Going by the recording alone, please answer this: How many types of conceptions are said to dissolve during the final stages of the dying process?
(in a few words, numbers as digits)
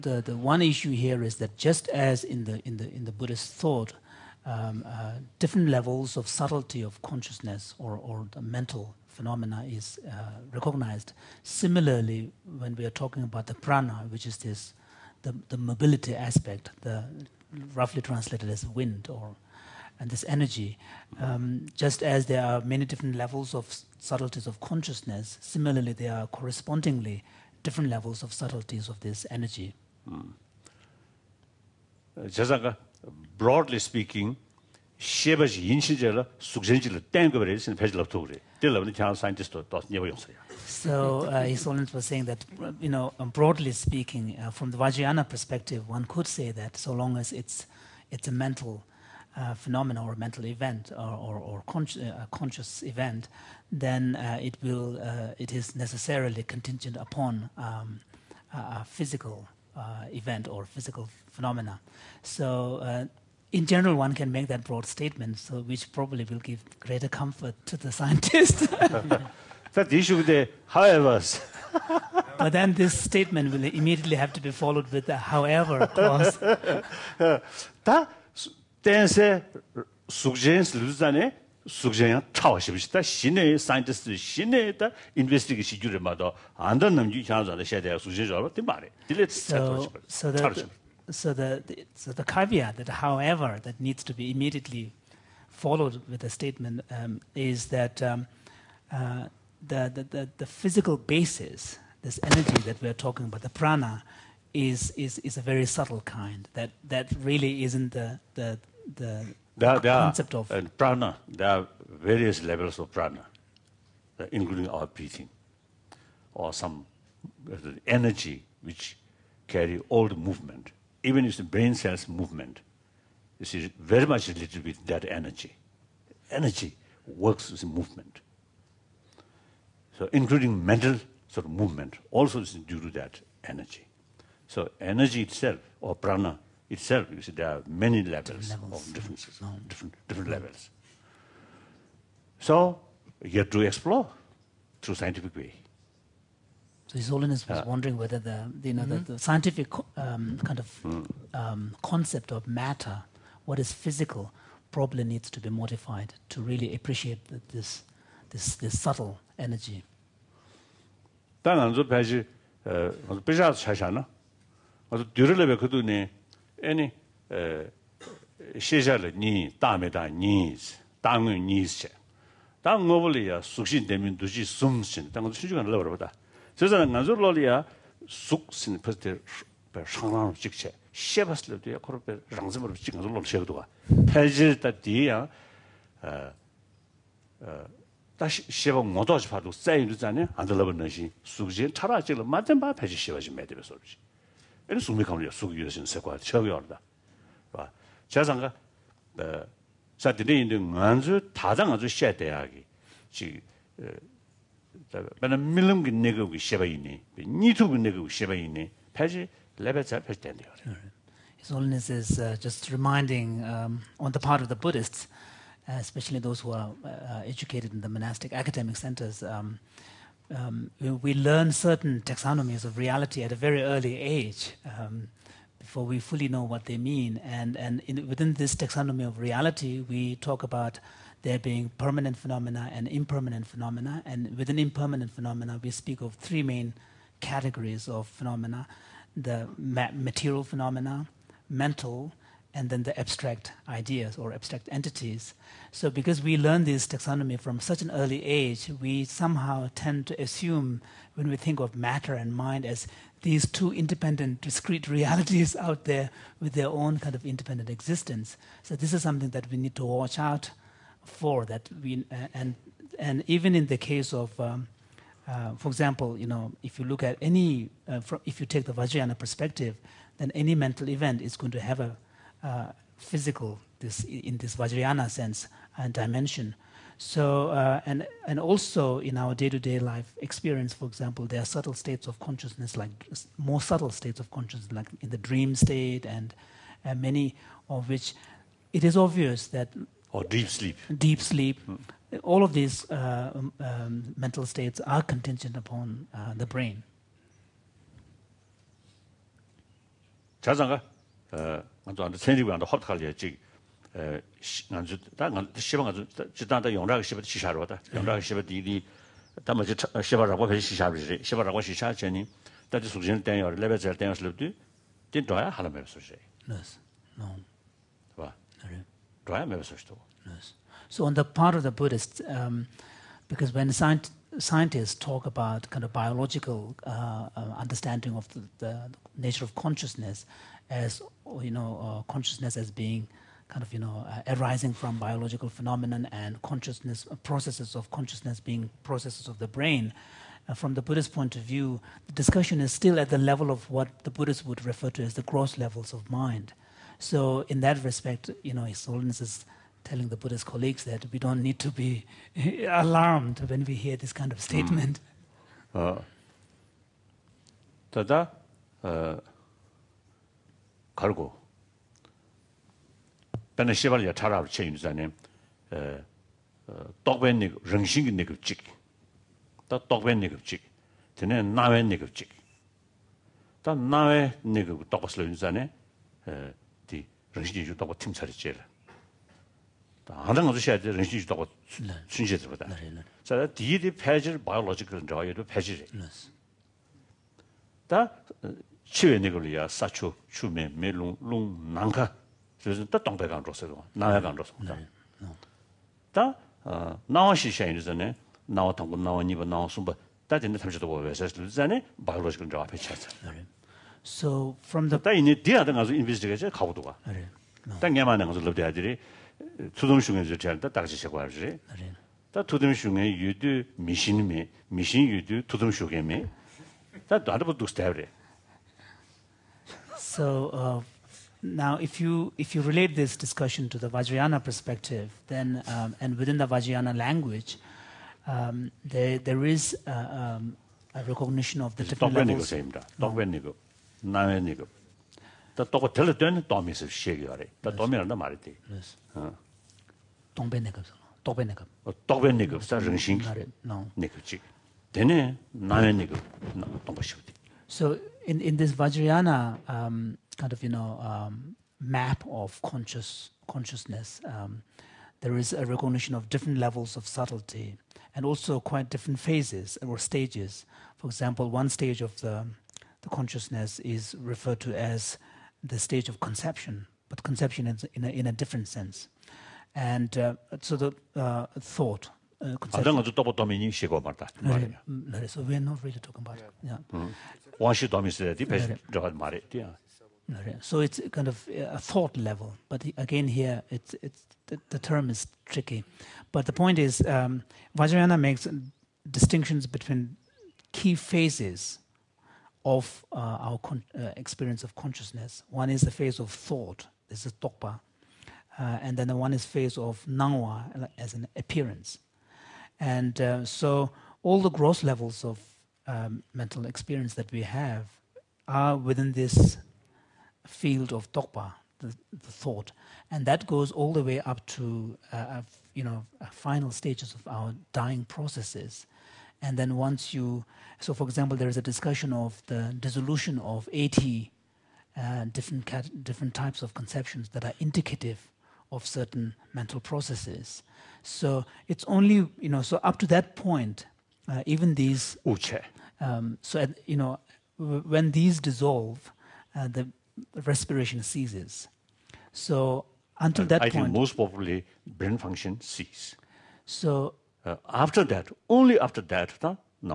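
80.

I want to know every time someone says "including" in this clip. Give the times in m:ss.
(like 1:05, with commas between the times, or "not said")
1:54, 2:10.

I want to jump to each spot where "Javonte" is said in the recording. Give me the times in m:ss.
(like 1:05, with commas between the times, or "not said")
not said.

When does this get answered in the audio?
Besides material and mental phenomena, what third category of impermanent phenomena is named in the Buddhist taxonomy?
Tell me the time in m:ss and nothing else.
4:04.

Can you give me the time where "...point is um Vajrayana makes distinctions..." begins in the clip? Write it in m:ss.
8:06.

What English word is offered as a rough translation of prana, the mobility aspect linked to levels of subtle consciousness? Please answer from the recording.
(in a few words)
Wind.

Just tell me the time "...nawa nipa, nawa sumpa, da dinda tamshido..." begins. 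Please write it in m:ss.
6:38.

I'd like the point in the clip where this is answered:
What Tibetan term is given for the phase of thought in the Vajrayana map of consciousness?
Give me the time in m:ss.
8:17.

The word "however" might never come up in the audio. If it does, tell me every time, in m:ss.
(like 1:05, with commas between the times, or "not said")
1:10, 1:15, 1:32.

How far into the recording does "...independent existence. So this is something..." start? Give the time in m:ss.
4:17.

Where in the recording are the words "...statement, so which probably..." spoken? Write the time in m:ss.
1:04.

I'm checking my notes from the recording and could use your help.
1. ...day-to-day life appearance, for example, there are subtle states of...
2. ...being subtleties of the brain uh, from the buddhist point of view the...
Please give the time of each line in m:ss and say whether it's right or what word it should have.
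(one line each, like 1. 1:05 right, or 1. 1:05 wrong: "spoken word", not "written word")
1. 4:39 wrong: "experience", not "appearance"
2. 5:38 wrong: "processes", not "subtleties".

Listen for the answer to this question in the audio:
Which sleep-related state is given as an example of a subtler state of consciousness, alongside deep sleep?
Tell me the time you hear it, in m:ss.
4:45.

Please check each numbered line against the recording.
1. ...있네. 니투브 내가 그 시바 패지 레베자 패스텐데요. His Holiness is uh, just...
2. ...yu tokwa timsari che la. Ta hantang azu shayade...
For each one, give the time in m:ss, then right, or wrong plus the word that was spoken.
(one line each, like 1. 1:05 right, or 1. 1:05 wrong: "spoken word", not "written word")
1. 3:26 right
2. 6:17 right.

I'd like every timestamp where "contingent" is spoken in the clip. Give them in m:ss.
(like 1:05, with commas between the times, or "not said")
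0:56, 4:55.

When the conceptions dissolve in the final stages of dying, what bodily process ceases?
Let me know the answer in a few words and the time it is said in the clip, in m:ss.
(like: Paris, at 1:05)
Respiration, at 9:00.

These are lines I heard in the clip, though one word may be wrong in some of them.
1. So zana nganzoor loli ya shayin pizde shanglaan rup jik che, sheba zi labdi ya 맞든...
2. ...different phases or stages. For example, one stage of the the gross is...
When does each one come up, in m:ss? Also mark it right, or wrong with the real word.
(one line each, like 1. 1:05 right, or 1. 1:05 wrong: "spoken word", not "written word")
1. 2:56 wrong: "sukshin", not "shayin"
2. 7:38 wrong: "consciousness", not "gross".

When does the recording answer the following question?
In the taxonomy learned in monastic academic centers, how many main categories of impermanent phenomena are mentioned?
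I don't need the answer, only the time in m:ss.
3:56.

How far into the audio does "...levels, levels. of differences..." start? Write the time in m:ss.
2:18.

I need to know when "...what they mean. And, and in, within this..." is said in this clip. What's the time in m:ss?
3:46.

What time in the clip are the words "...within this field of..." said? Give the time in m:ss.
8:28.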